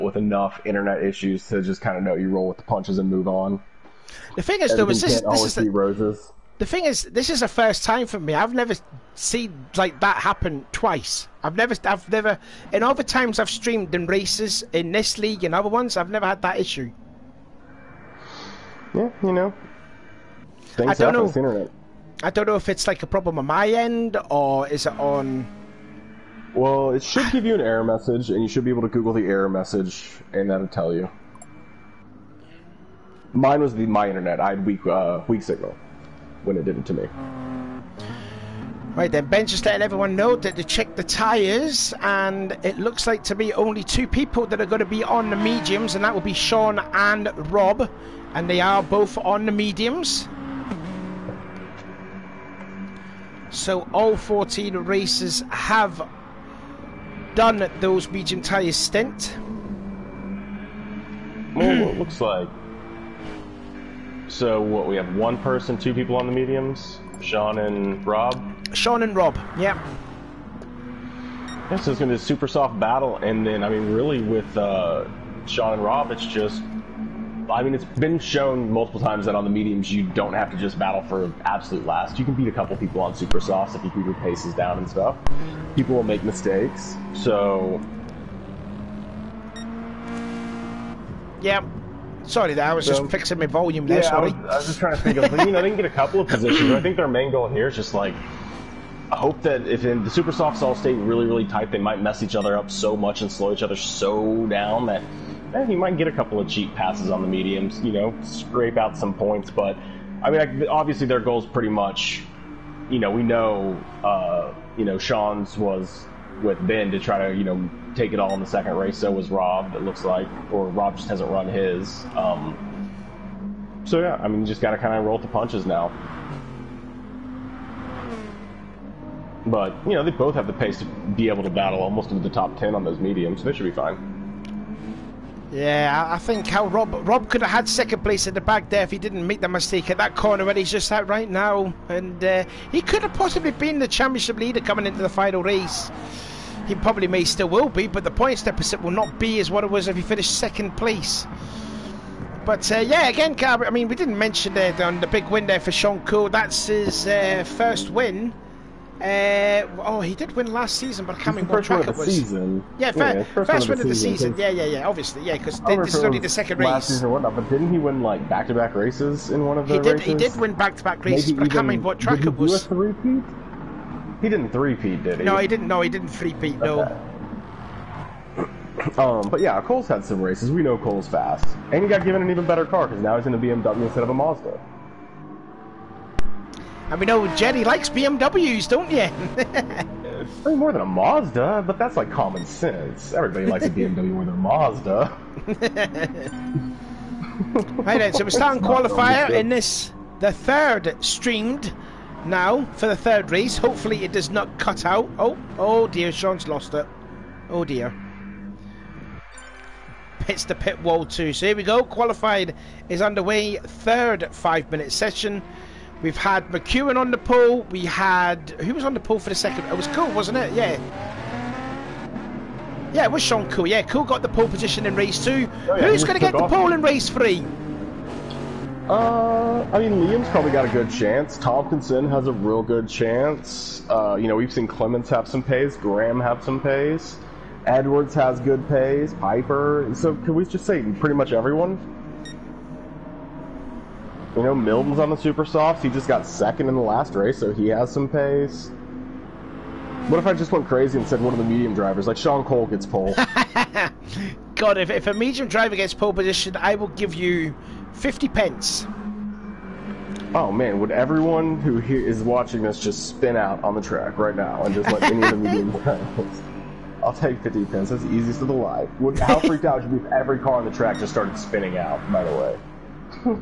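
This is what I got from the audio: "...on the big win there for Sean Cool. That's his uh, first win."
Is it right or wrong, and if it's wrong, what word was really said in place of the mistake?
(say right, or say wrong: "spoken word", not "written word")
right.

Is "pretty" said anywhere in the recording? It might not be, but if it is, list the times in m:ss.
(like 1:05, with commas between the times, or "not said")
1:51, 4:00.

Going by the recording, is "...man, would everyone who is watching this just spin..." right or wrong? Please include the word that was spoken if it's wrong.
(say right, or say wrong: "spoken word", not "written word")
right.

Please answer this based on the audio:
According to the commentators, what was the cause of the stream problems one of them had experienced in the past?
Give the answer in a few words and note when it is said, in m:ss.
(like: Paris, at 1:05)
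Weak signal, at 0:35.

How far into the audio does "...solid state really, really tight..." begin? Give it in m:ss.
1:40.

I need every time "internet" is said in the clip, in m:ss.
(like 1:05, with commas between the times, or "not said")
0:00, 0:21, 0:34.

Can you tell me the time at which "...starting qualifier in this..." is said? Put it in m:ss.
3:18.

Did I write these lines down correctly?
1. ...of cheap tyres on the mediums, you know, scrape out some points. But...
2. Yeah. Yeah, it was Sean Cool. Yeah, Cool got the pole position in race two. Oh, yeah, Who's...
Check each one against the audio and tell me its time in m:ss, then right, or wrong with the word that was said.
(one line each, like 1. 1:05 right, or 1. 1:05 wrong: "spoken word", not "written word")
1. 1:46 wrong: "passes", not "tyres"
2. 3:40 right.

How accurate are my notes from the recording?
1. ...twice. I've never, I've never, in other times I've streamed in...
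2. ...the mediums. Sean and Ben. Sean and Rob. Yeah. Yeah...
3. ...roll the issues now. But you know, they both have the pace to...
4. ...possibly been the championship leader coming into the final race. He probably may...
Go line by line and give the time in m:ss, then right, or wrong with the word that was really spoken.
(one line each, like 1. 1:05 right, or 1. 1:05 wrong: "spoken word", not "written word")
1. 0:10 right
2. 1:06 wrong: "Rob", not "Ben"
3. 2:05 wrong: "punches", not "issues"
4. 2:23 right.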